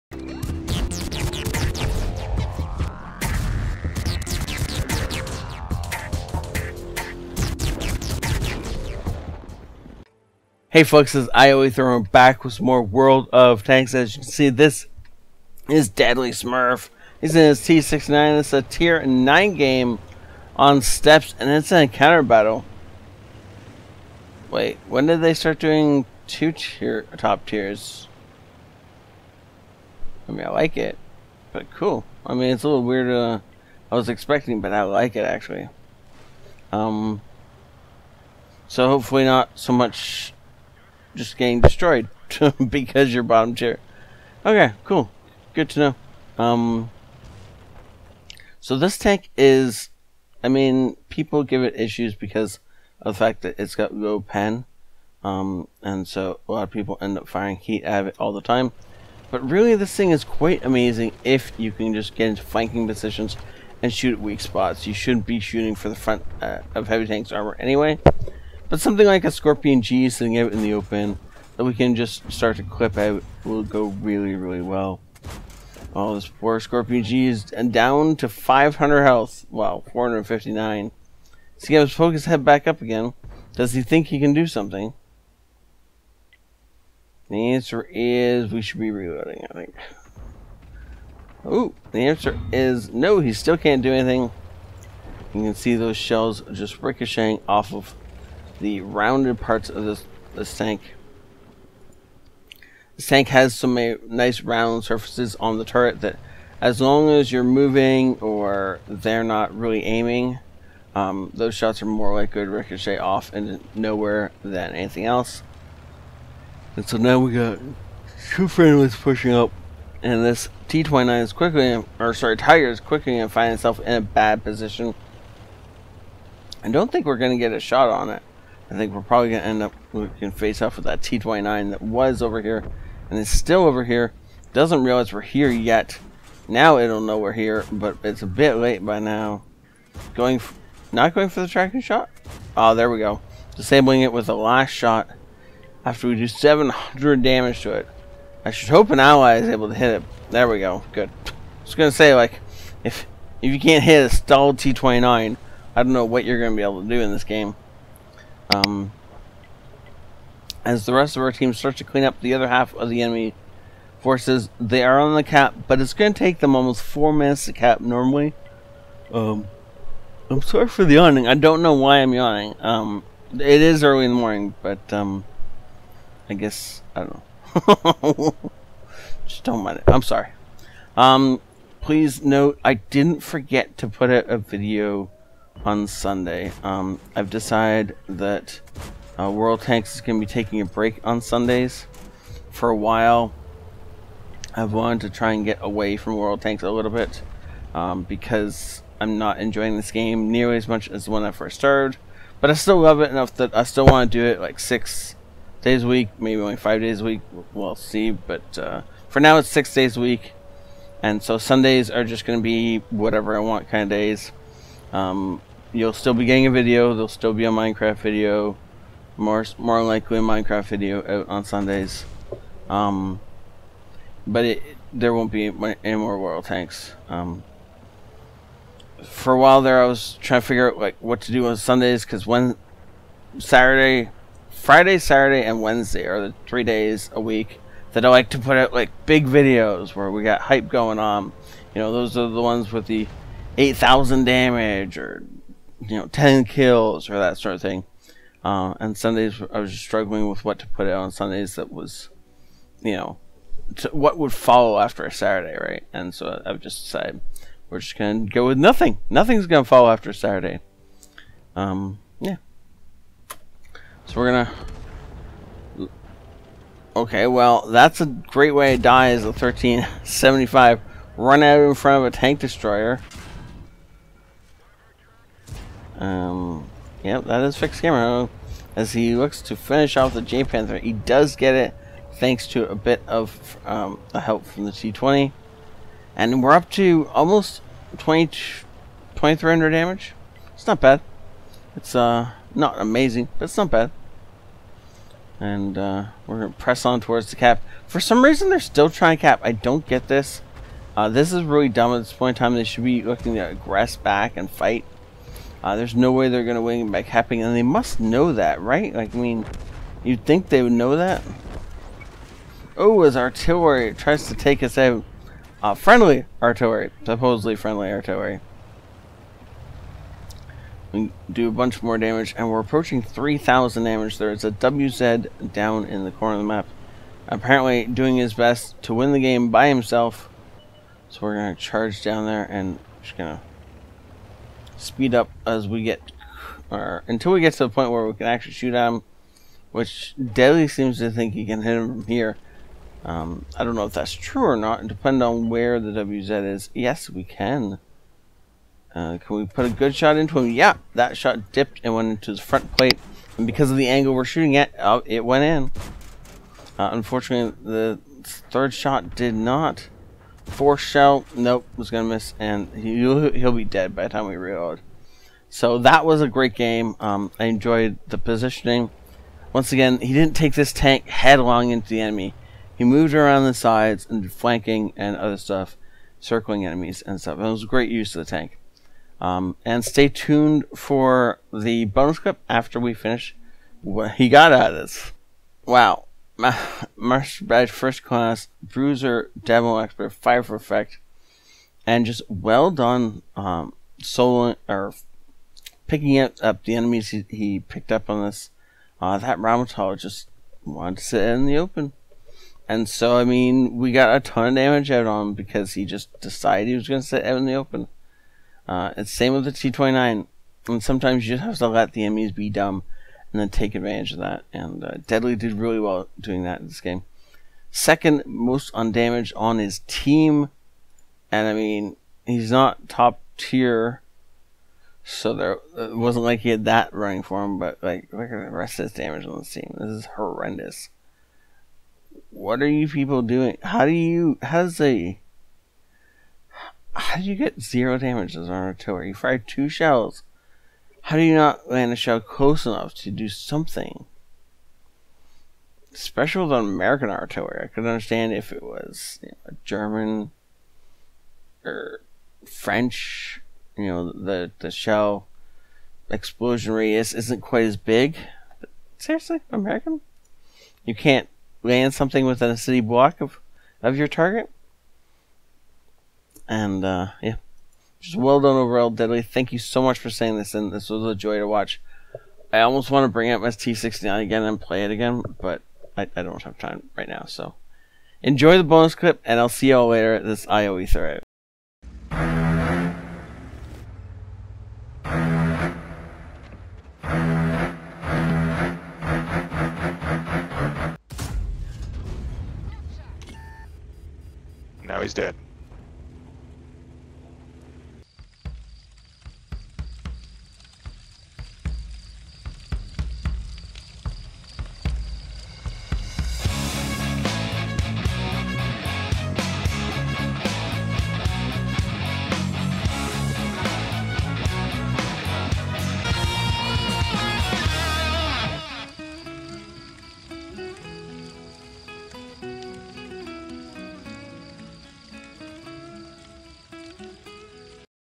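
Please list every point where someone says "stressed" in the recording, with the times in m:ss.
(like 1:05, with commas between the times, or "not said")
not said.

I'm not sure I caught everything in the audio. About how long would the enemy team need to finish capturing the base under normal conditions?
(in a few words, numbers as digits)
almost four minutes.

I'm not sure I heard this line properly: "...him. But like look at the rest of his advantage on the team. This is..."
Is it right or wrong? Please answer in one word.
wrong.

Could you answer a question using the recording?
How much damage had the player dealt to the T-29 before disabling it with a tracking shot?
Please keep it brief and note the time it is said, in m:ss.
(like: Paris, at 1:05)
700, at 2:26.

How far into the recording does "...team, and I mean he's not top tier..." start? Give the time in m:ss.
6:59.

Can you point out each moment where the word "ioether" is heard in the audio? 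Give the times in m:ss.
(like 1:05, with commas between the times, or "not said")
8:00.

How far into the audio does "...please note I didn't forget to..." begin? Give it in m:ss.
3:01.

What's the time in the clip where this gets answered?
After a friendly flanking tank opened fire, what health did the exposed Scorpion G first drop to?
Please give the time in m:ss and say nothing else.
1:18.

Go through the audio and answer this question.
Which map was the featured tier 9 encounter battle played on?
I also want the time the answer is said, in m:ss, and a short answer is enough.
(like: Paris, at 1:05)
Steppes, at 0:20.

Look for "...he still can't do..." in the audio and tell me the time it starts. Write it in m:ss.
1:33.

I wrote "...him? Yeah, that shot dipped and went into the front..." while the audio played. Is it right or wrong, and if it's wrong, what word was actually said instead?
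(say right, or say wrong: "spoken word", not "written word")
right.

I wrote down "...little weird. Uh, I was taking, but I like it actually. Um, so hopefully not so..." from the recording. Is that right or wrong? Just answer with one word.
wrong.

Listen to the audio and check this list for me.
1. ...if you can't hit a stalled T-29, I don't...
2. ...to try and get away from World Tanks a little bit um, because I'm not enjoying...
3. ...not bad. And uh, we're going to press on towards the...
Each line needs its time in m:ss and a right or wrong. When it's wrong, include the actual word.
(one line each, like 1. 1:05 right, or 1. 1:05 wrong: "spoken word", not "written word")
1. 2:33 right
2. 3:15 right
3. 4:53 right.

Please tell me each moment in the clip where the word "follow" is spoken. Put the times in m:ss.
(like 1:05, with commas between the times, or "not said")
4:14, 4:19.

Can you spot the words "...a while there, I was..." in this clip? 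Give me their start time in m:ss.
3:49.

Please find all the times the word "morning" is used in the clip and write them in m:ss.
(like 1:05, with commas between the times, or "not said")
2:54.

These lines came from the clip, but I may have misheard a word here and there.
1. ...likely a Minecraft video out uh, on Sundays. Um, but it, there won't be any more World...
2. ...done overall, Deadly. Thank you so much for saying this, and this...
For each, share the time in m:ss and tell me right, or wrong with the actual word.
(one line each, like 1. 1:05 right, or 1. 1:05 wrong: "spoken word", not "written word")
1. 3:39 right
2. 7:48 right.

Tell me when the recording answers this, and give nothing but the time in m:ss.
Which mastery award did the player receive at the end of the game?
6:27.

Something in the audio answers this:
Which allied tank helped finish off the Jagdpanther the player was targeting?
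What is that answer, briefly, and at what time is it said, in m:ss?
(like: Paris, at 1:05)
T20, at 4:44.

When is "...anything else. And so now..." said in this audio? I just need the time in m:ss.
1:54.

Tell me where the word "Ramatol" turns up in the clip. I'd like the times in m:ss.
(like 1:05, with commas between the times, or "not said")
6:39.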